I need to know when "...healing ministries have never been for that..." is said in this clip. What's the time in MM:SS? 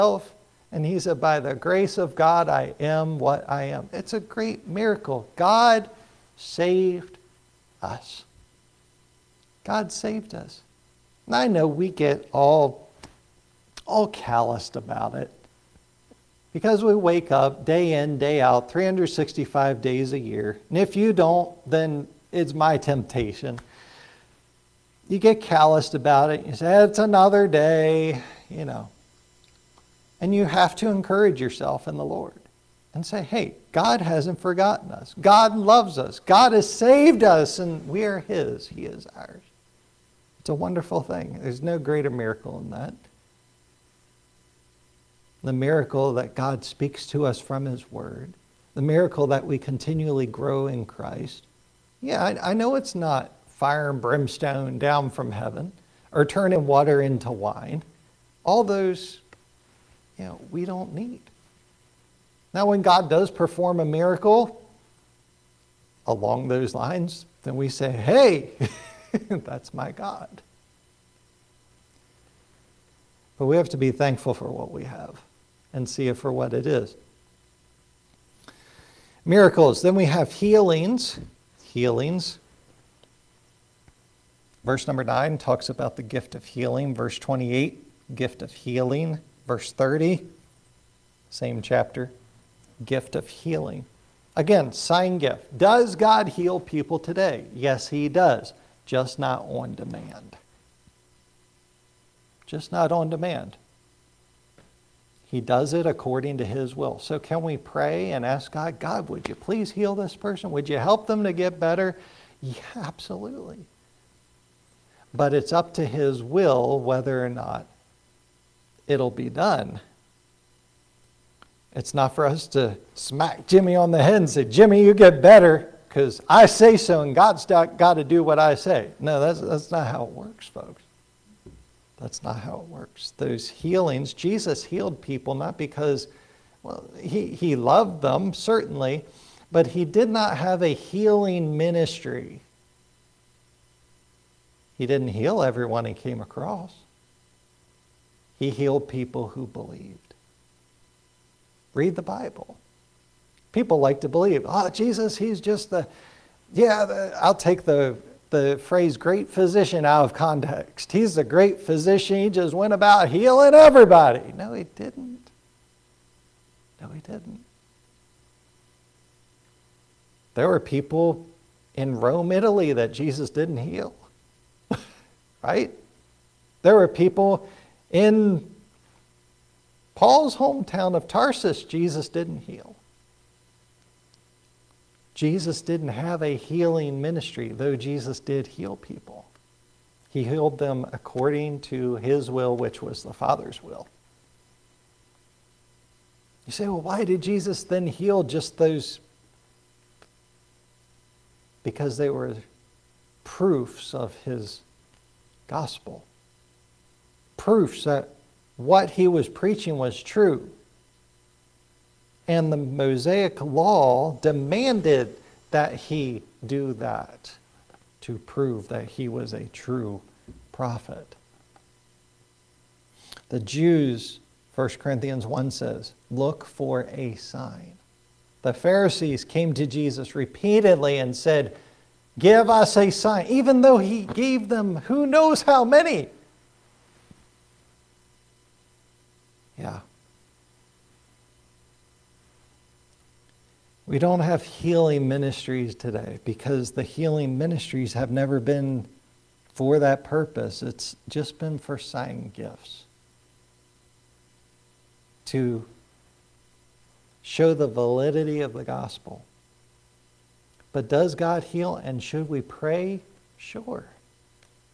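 04:06.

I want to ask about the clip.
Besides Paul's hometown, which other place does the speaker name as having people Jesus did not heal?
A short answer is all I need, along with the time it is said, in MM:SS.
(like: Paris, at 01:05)
Rome, Italy, at 02:51.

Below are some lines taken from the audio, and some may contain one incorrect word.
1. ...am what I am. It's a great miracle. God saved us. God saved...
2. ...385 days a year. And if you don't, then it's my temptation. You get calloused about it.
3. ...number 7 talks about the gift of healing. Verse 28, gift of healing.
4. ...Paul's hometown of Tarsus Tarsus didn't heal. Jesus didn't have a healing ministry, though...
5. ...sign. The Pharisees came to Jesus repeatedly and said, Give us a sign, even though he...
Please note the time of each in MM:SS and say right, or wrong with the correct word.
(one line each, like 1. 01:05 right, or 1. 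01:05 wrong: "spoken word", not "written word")
1. 00:02 right
2. 00:18 wrong: "365", not "385"
3. 01:24 wrong: "9", not "7"
4. 02:59 wrong: "Jesus", not "Tarsus"
5. 03:47 right.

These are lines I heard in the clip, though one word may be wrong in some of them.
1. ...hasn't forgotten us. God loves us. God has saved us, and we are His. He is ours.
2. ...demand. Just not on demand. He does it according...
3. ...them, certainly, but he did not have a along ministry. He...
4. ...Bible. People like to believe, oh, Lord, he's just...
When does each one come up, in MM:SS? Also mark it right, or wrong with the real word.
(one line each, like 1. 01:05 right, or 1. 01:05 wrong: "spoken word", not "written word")
1. 00:34 right
2. 01:39 right
3. 02:18 wrong: "healing", not "along"
4. 02:32 wrong: "Jesus", not "Lord".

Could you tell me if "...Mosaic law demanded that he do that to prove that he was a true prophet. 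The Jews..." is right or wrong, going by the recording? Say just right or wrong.
right.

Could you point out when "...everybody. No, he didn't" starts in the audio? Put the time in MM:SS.
02:43.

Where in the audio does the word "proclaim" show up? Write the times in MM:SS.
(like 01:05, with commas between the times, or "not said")
not said.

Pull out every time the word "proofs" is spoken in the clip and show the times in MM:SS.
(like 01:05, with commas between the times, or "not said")
03:23, 03:27.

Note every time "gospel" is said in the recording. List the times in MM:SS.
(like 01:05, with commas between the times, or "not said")
03:25, 04:18.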